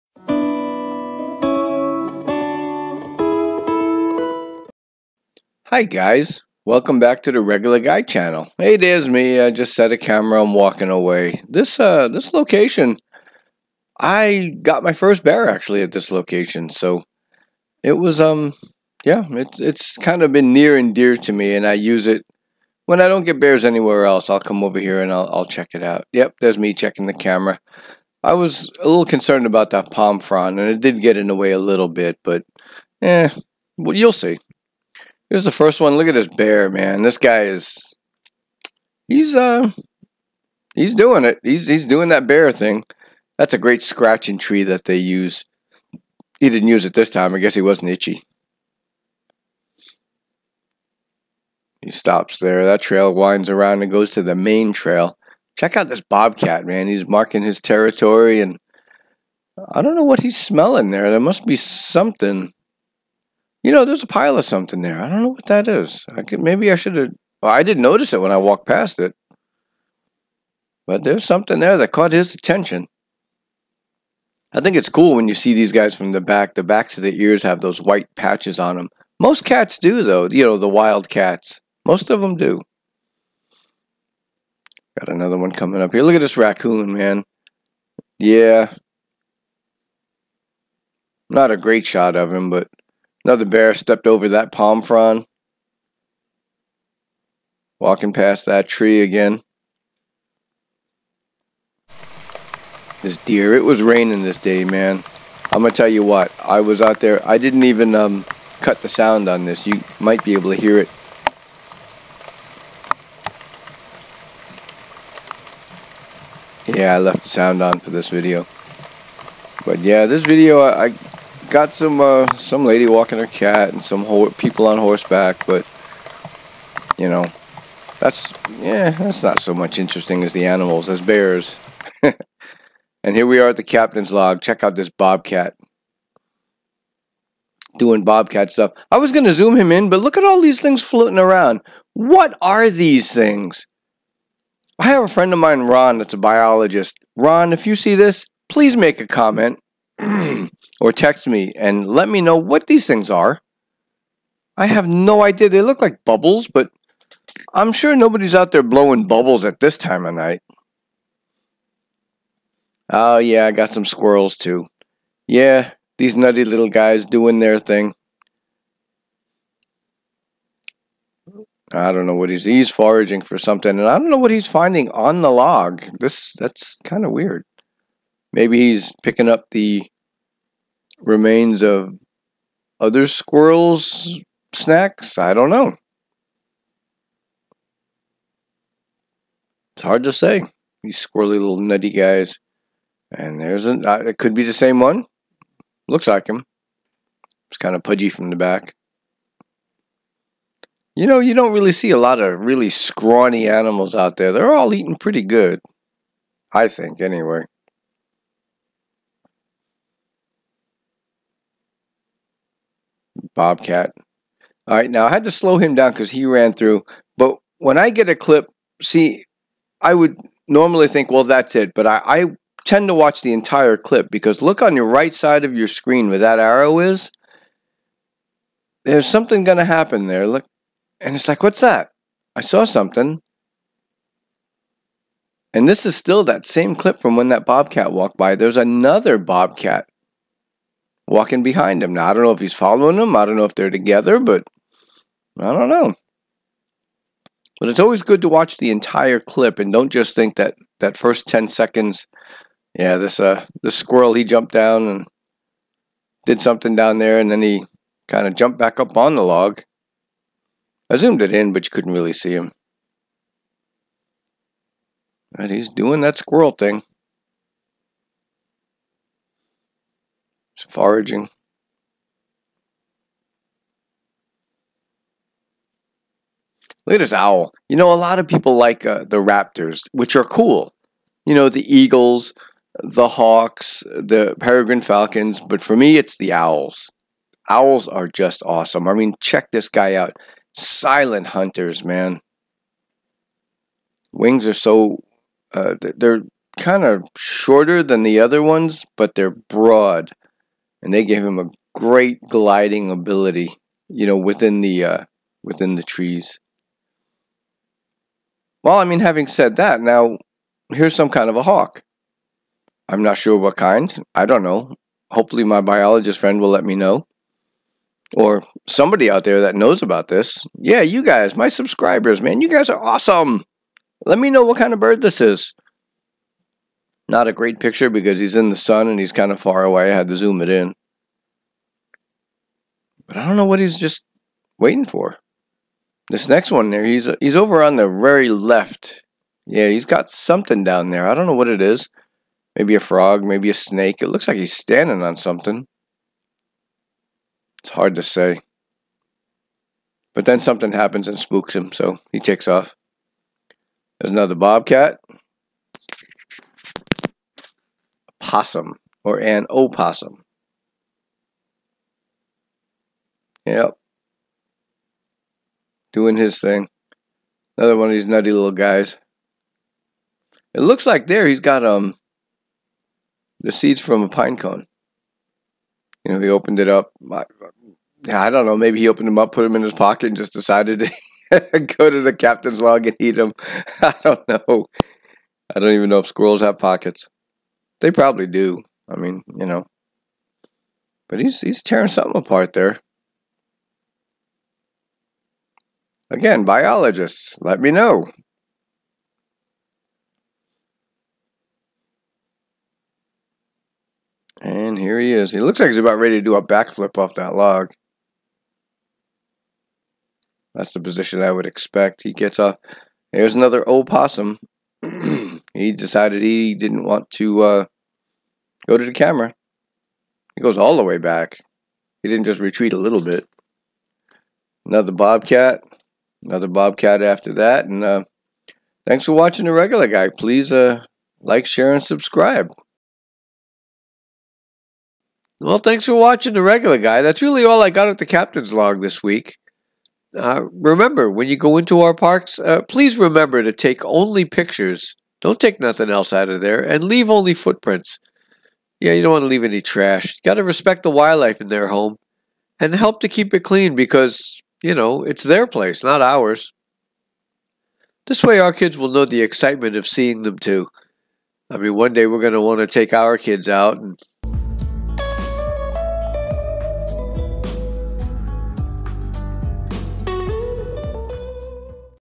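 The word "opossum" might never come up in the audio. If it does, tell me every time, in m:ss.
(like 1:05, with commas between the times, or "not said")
5:59, 6:53.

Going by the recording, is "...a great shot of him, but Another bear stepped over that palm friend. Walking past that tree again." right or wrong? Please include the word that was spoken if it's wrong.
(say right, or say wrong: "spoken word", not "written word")
wrong: "frond", not "friend".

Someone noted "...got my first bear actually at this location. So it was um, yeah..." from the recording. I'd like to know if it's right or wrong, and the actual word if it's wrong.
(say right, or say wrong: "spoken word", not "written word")
right.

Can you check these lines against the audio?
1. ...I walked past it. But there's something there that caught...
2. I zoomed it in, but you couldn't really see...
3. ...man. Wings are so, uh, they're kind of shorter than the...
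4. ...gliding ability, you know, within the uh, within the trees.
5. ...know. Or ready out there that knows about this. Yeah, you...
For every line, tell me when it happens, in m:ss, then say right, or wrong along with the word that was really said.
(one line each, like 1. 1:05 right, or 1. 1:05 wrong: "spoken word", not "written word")
1. 1:08 right
2. 4:20 right
3. 4:51 right
4. 5:02 right
5. 5:16 wrong: "somebody", not "ready".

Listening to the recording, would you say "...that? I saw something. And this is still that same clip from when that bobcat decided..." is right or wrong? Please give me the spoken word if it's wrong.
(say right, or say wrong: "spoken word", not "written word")
wrong: "walked", not "decided".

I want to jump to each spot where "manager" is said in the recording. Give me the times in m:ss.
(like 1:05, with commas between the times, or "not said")
not said.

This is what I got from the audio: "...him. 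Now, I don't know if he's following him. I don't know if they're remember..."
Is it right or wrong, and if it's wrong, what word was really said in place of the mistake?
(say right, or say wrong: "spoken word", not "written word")
wrong: "together", not "remember".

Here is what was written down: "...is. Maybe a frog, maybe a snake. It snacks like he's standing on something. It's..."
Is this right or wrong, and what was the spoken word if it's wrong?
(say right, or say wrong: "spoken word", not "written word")
wrong: "looks", not "snacks".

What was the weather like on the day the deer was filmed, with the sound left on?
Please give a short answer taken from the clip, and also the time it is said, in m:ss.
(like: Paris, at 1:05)
raining, at 1:43.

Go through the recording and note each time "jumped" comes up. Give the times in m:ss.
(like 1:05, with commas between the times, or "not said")
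4:14, 4:18.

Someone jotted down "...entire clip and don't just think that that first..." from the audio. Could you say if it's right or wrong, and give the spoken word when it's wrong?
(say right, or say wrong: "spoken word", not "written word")
right.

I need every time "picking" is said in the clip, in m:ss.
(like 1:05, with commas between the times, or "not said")
2:59.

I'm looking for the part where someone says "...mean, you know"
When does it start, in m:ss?
6:28.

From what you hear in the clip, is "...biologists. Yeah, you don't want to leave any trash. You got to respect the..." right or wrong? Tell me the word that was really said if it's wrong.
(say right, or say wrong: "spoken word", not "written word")
wrong: "footprints", not "biologists".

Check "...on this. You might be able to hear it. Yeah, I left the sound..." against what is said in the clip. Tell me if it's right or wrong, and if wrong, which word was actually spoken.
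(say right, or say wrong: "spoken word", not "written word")
right.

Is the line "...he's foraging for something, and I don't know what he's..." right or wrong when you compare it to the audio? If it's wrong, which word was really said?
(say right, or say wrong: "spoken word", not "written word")
right.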